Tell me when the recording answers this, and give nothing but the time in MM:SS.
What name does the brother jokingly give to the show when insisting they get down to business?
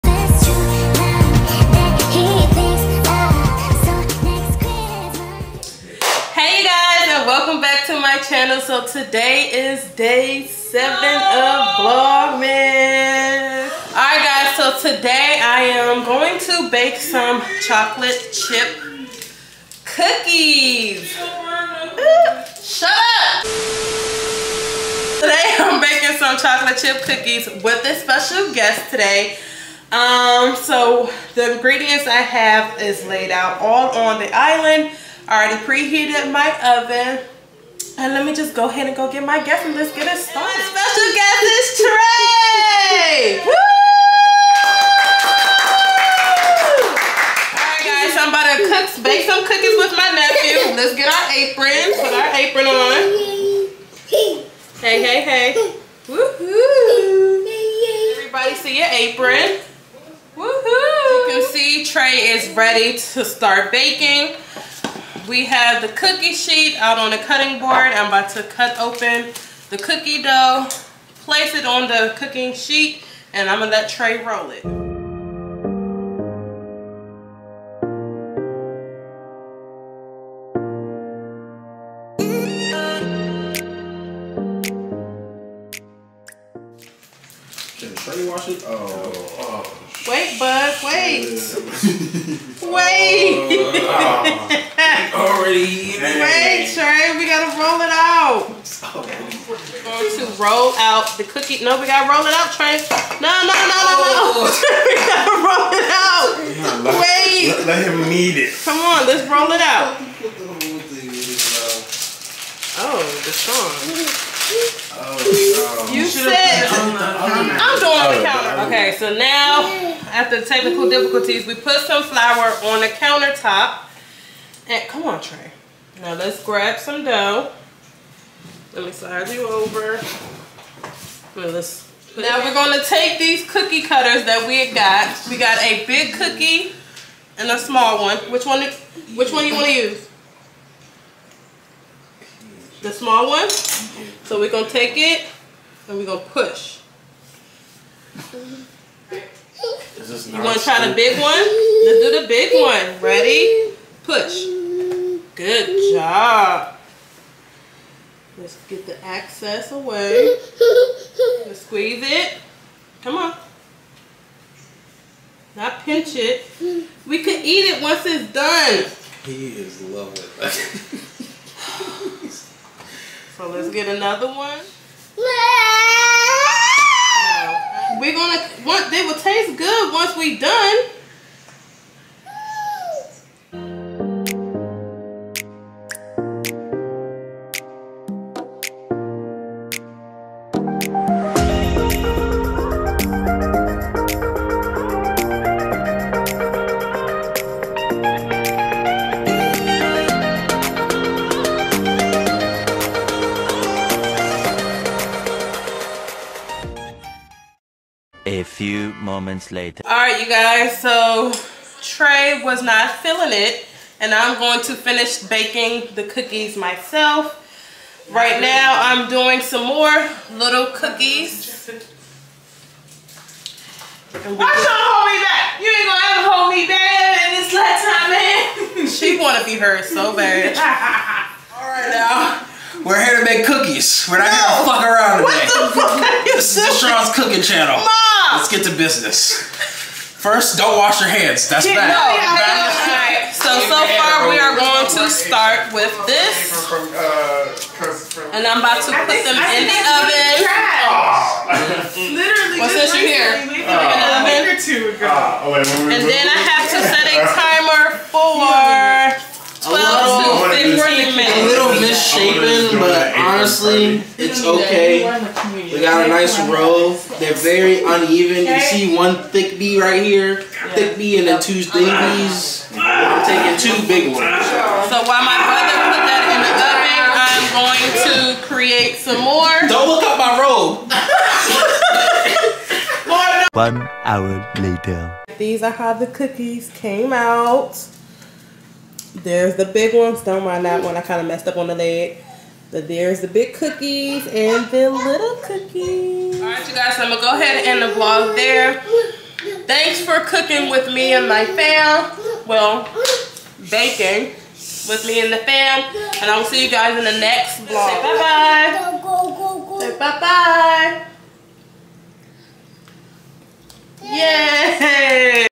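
03:56.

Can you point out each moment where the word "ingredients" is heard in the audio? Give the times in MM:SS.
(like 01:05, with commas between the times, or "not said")
00:31.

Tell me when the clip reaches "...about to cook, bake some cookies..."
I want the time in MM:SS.
00:48.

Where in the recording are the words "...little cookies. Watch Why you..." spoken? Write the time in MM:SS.
03:40.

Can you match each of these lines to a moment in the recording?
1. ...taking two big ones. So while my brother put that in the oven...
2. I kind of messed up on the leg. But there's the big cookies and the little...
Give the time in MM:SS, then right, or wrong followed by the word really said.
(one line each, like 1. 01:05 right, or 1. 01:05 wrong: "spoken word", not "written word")
1. 04:33 right
2. 04:50 right.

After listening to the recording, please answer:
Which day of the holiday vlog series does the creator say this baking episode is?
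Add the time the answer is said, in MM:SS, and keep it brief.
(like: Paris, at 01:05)
Day 7, at 00:09.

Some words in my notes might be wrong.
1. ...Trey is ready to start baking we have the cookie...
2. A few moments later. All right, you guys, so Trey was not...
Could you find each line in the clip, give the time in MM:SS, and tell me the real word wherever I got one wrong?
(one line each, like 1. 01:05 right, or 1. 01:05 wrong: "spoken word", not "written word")
1. 01:01 right
2. 03:28 right.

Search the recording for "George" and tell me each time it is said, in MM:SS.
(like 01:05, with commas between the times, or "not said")
not said.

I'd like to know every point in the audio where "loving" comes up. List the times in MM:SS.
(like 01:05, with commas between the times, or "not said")
02:49.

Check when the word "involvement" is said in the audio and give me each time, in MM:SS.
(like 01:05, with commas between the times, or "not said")
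not said.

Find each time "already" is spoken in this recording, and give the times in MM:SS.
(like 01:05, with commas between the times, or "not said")
00:35, 01:35.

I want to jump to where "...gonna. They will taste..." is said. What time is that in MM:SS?
02:58.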